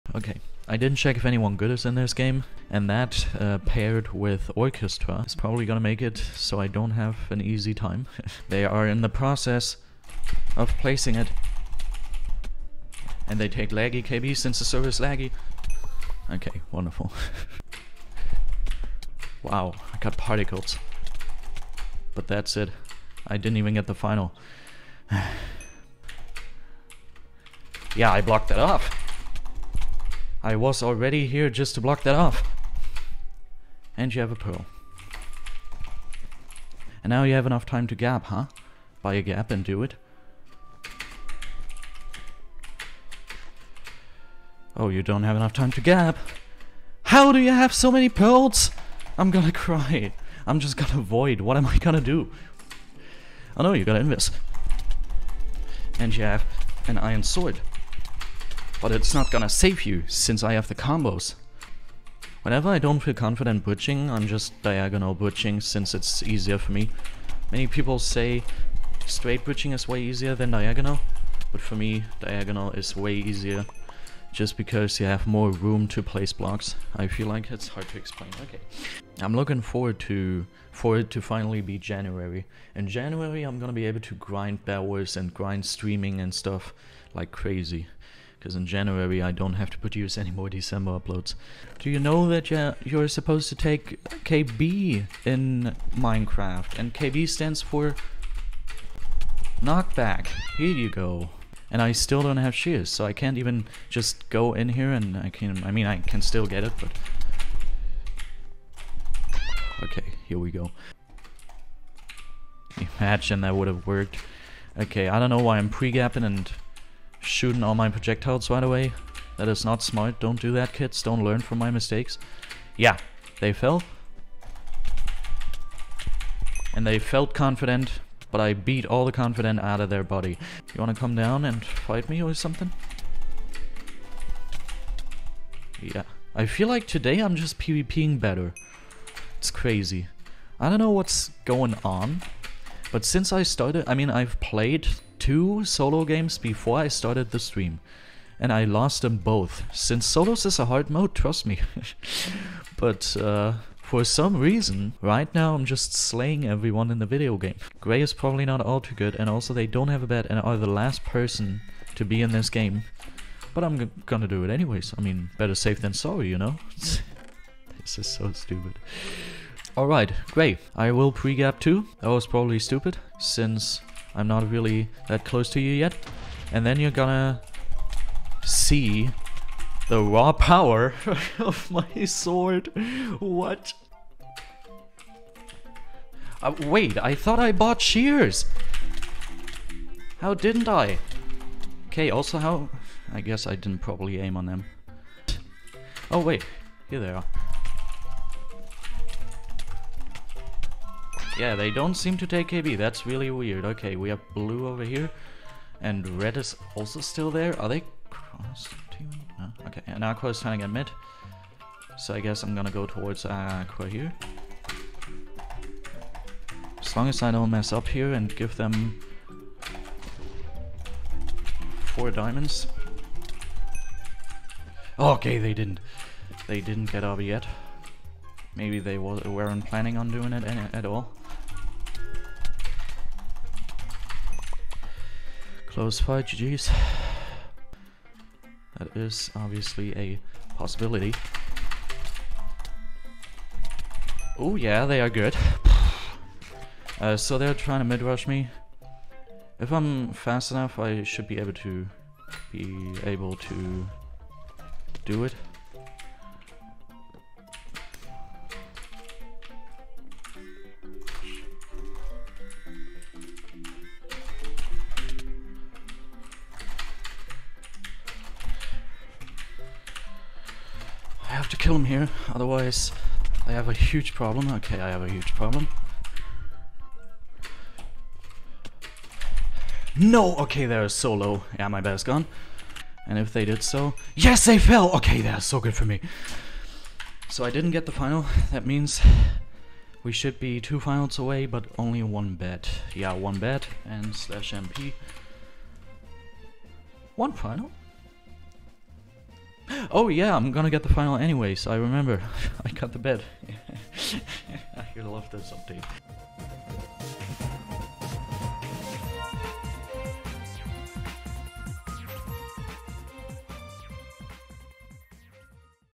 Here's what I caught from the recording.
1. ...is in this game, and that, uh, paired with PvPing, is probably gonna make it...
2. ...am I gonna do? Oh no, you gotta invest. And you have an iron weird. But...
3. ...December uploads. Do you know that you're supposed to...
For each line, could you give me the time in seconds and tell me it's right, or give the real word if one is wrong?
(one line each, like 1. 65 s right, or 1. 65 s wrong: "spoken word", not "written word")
1. 1 s wrong: "Orchestra", not "PvPing"
2. 51 s wrong: "sword", not "weird"
3. 90 s right.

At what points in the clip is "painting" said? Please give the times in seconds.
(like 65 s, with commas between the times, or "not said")
not said.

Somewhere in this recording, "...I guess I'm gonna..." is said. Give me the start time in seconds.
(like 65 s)
212 s.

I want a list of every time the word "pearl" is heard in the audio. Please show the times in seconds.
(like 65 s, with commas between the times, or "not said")
34 s, 48 s.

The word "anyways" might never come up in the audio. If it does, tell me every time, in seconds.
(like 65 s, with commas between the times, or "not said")
164 s, 301 s.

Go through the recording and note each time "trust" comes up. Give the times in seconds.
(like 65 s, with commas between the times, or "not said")
151 s.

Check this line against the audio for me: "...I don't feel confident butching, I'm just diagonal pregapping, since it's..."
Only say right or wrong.
wrong.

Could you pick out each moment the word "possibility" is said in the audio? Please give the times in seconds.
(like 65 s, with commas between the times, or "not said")
240 s.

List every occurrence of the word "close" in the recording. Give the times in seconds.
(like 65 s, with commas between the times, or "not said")
175 s, 235 s.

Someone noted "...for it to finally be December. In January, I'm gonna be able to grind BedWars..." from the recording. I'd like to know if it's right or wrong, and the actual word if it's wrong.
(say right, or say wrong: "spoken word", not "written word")
wrong: "January", not "December".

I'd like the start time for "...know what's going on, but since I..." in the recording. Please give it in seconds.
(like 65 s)
140 s.